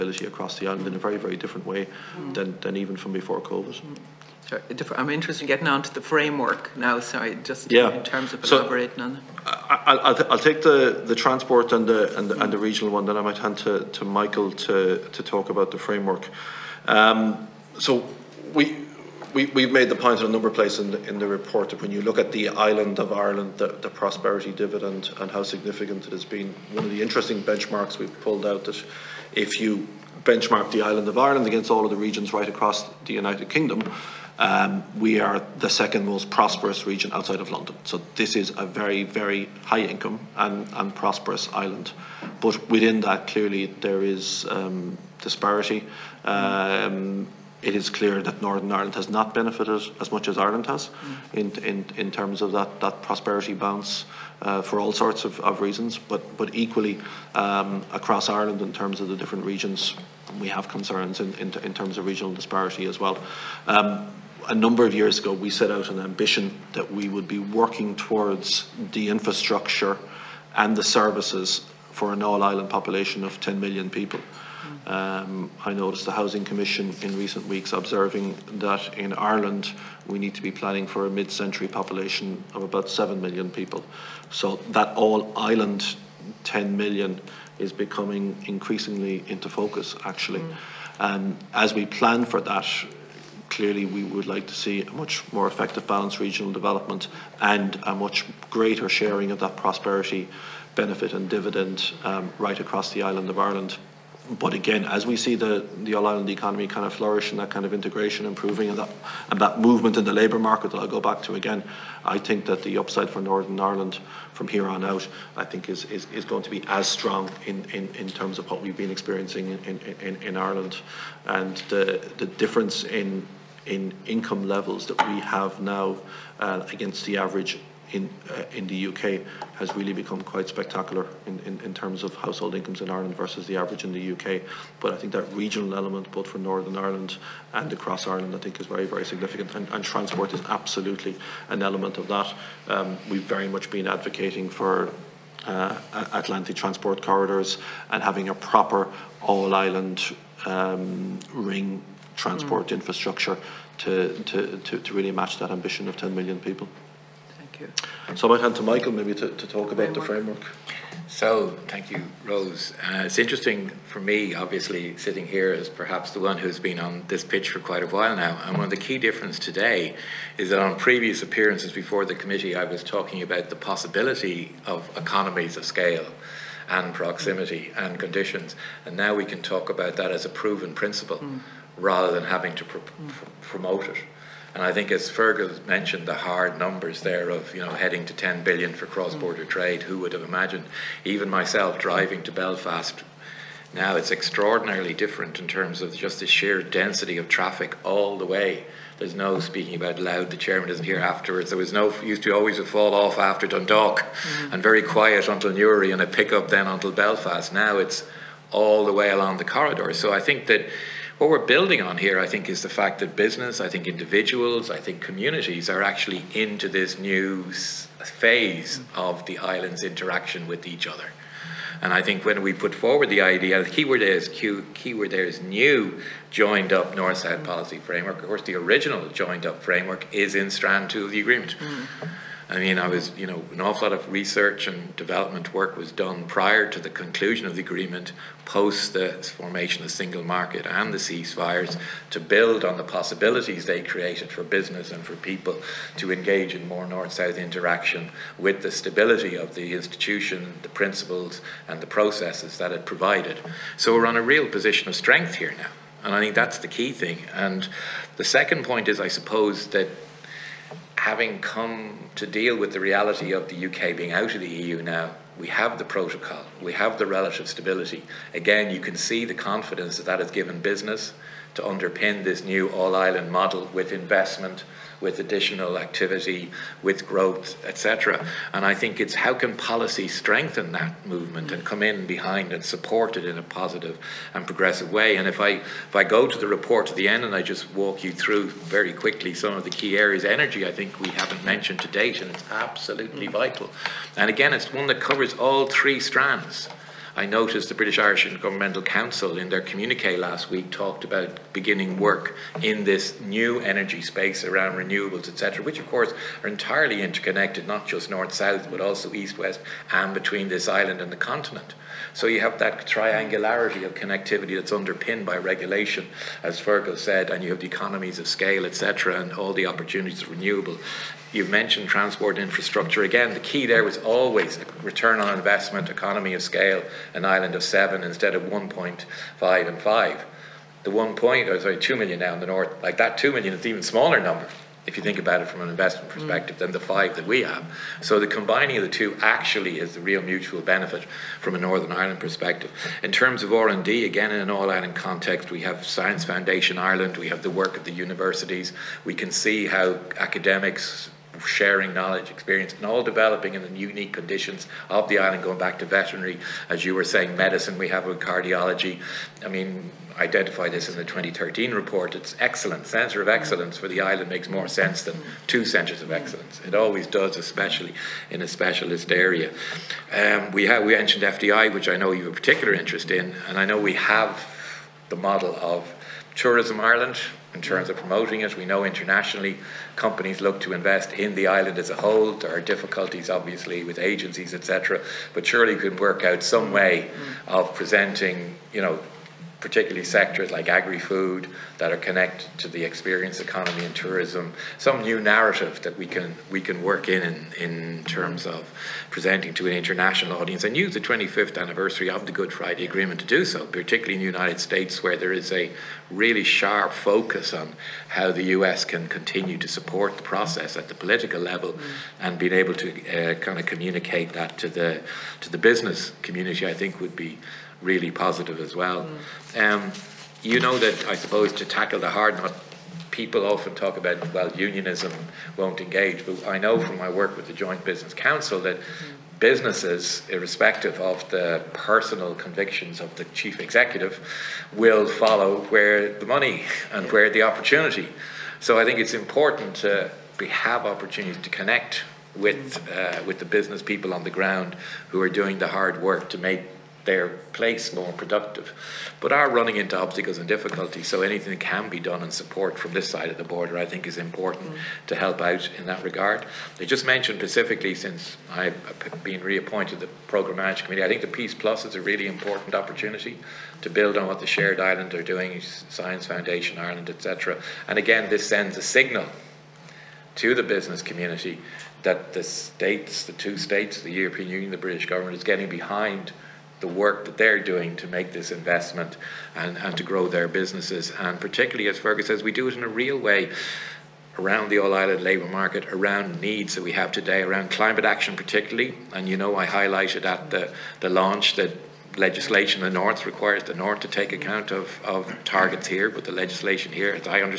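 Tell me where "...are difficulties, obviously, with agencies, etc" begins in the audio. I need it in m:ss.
6:22.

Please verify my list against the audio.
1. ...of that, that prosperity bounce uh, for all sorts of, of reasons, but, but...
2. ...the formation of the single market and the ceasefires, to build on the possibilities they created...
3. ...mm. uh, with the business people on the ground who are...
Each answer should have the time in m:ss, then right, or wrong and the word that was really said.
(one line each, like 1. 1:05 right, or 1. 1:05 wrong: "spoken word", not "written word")
1. 0:52 right
2. 3:58 right
3. 7:22 right.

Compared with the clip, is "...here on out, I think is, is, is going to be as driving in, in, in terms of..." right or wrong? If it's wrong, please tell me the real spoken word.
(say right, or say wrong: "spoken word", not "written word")
wrong: "strong", not "driving".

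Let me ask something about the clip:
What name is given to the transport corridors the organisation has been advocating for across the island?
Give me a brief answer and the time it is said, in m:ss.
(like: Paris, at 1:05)
Atlantic, at 2:26.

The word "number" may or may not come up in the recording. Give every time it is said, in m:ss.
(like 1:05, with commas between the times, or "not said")
0:20, 1:04, 3:06, 5:34.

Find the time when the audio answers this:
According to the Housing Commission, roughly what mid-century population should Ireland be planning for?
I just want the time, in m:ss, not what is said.
1:22.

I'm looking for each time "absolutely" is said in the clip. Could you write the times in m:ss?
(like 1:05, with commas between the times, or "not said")
2:20, 4:52.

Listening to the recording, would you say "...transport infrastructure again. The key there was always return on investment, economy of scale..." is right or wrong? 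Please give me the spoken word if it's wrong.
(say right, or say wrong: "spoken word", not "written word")
right.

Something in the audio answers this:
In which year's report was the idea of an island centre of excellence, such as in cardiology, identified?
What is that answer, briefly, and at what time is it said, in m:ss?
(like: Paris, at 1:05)
2013, at 6:01.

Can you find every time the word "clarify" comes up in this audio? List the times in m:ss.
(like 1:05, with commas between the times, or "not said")
not said.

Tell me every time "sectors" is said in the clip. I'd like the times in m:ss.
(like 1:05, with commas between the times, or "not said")
6:30.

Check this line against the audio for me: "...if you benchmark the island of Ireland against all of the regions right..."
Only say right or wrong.
right.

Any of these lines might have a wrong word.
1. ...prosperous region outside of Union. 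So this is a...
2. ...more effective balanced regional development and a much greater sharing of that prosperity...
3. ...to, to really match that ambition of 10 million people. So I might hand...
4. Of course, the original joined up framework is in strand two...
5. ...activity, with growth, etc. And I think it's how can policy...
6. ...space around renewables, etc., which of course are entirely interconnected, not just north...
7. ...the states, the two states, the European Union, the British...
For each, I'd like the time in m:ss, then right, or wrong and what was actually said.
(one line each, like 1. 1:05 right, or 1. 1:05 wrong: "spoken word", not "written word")
1. 0:36 wrong: "London", not "Union"
2. 1:35 right
3. 2:34 right
4. 3:48 right
5. 4:35 right
6. 5:04 right
7. 7:52 right.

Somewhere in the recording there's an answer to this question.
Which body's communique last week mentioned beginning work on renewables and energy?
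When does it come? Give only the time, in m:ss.
4:57.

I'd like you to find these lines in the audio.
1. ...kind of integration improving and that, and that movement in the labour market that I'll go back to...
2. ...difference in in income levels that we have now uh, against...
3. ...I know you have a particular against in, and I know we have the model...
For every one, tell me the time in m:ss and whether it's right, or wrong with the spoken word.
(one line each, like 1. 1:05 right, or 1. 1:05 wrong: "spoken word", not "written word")
1. 1:47 right
2. 2:02 right
3. 6:11 wrong: "interest", not "against".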